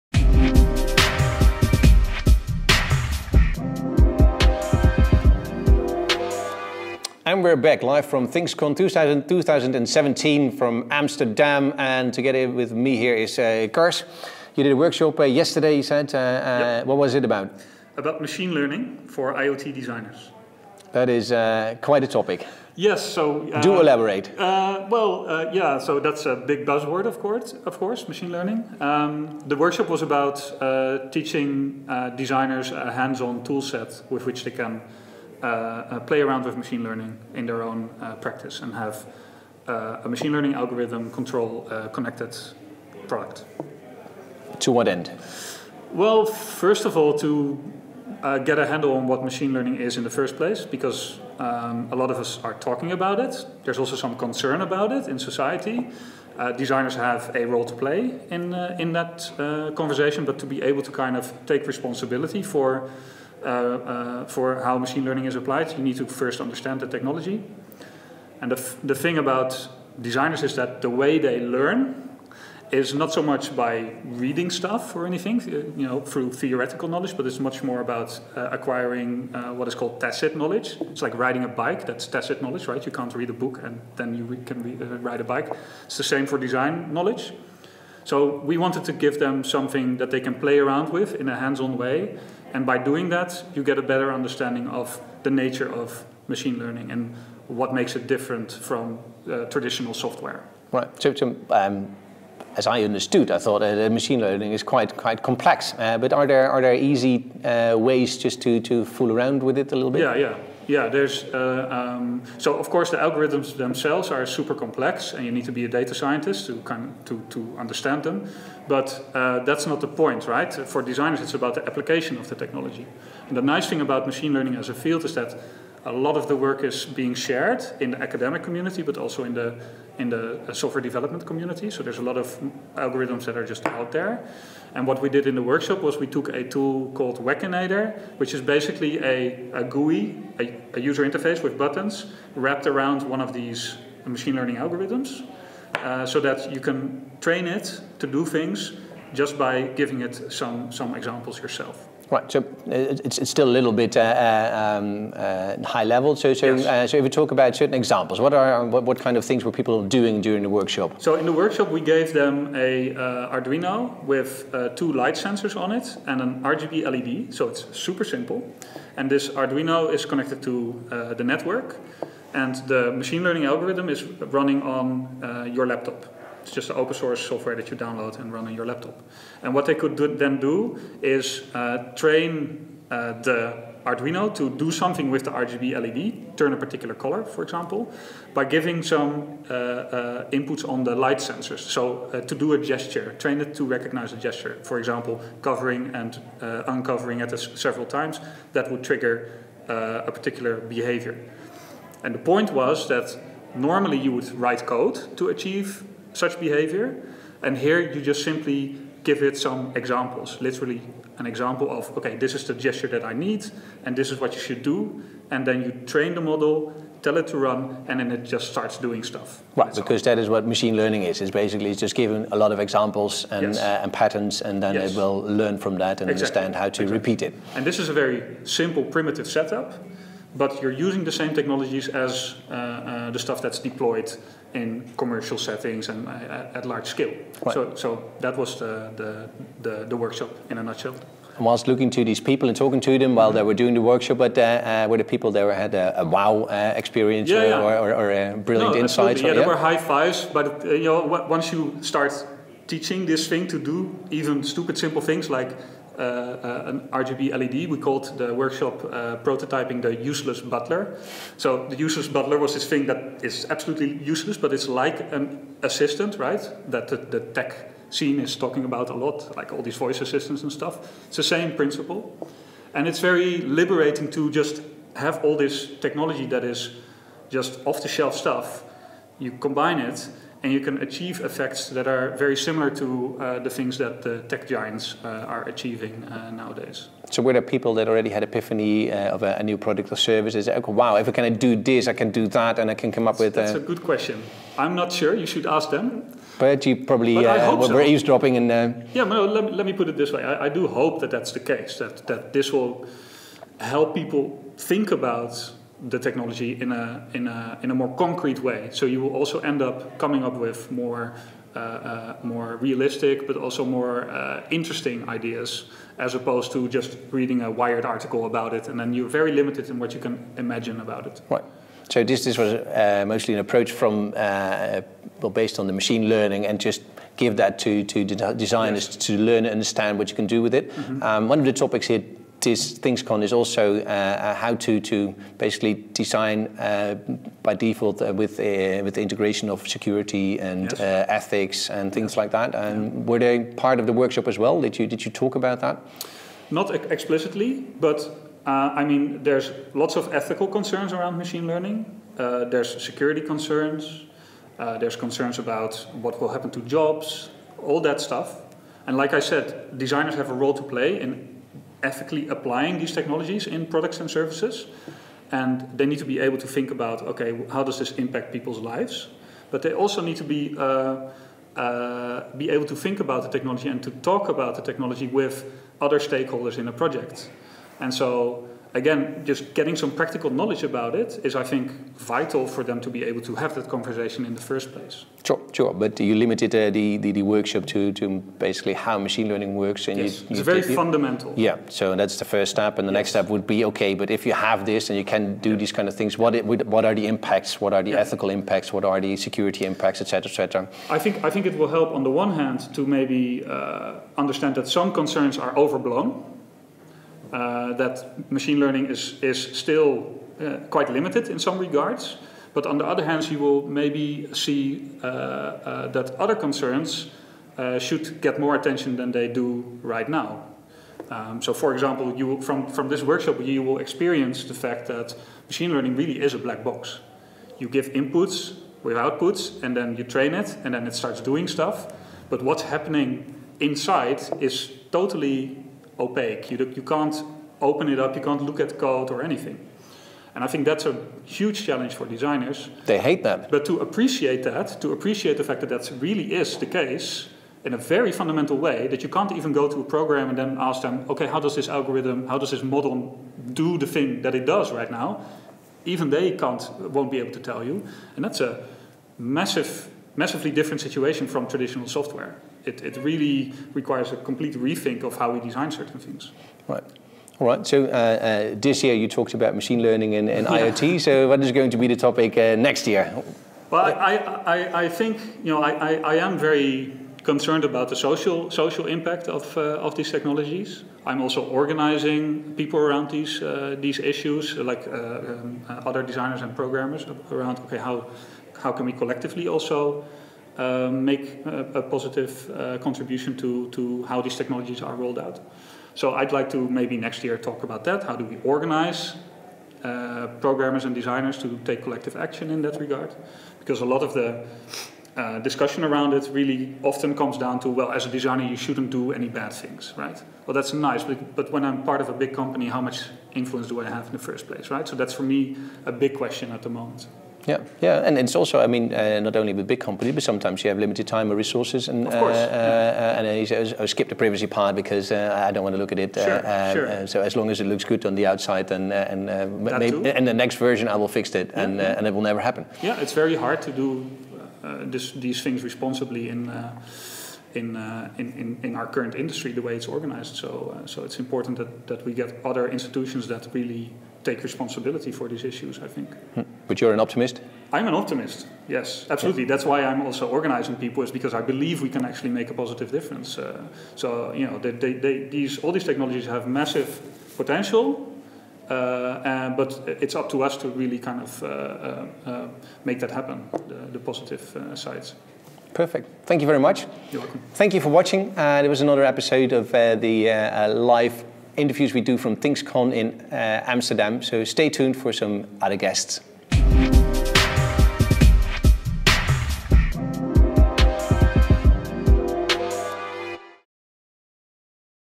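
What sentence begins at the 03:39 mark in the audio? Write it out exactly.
Right, because that is what machine learning is.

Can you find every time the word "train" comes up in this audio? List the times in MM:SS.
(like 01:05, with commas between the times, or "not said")
02:27, 03:01, 03:13, 03:35, 07:10.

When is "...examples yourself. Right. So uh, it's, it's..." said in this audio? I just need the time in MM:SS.
02:30.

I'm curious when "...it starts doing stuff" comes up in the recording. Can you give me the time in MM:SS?
07:10.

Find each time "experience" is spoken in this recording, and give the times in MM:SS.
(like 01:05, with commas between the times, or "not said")
04:06, 07:03.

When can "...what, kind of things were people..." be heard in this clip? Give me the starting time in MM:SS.
02:38.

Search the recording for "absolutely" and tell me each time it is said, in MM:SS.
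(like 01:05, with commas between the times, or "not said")
04:23, 09:09.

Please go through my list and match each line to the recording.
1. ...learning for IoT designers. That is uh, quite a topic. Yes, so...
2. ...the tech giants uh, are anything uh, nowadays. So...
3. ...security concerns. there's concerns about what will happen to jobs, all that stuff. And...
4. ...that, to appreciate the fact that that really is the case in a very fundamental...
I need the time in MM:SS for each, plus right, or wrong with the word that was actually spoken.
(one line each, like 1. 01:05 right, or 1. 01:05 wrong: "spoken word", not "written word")
1. 00:18 right
2. 04:44 wrong: "achieving", not "anything"
3. 05:52 right
4. 07:24 right.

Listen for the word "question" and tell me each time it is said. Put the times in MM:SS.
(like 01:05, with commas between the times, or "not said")
04:53, 08:36.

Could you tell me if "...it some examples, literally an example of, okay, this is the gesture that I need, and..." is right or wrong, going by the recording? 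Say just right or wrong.
right.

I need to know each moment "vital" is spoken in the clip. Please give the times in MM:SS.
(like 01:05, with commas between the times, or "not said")
06:21.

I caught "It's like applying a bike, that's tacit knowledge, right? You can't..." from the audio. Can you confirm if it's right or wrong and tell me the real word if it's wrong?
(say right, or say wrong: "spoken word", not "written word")
wrong: "riding", not "applying".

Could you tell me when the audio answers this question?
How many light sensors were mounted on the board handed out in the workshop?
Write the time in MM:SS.
02:44.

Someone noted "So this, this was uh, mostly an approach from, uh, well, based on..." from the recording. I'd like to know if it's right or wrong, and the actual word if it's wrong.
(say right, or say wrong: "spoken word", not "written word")
right.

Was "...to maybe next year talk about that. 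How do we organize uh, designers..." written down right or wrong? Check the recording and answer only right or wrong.
wrong.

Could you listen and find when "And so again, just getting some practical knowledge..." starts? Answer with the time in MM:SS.
06:17.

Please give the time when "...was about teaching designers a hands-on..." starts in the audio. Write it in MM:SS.
00:29.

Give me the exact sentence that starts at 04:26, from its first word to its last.
That the, the tech scene is talking about a lot, like all these voice assistants and stuff.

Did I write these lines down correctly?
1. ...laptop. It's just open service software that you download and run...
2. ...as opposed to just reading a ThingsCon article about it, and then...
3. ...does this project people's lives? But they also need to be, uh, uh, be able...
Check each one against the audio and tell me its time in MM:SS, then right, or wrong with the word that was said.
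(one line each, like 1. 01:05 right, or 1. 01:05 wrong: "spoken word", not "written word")
1. 02:55 wrong: "source", not "service"
2. 05:15 wrong: "Wired", not "ThingsCon"
3. 06:07 wrong: "impact", not "project".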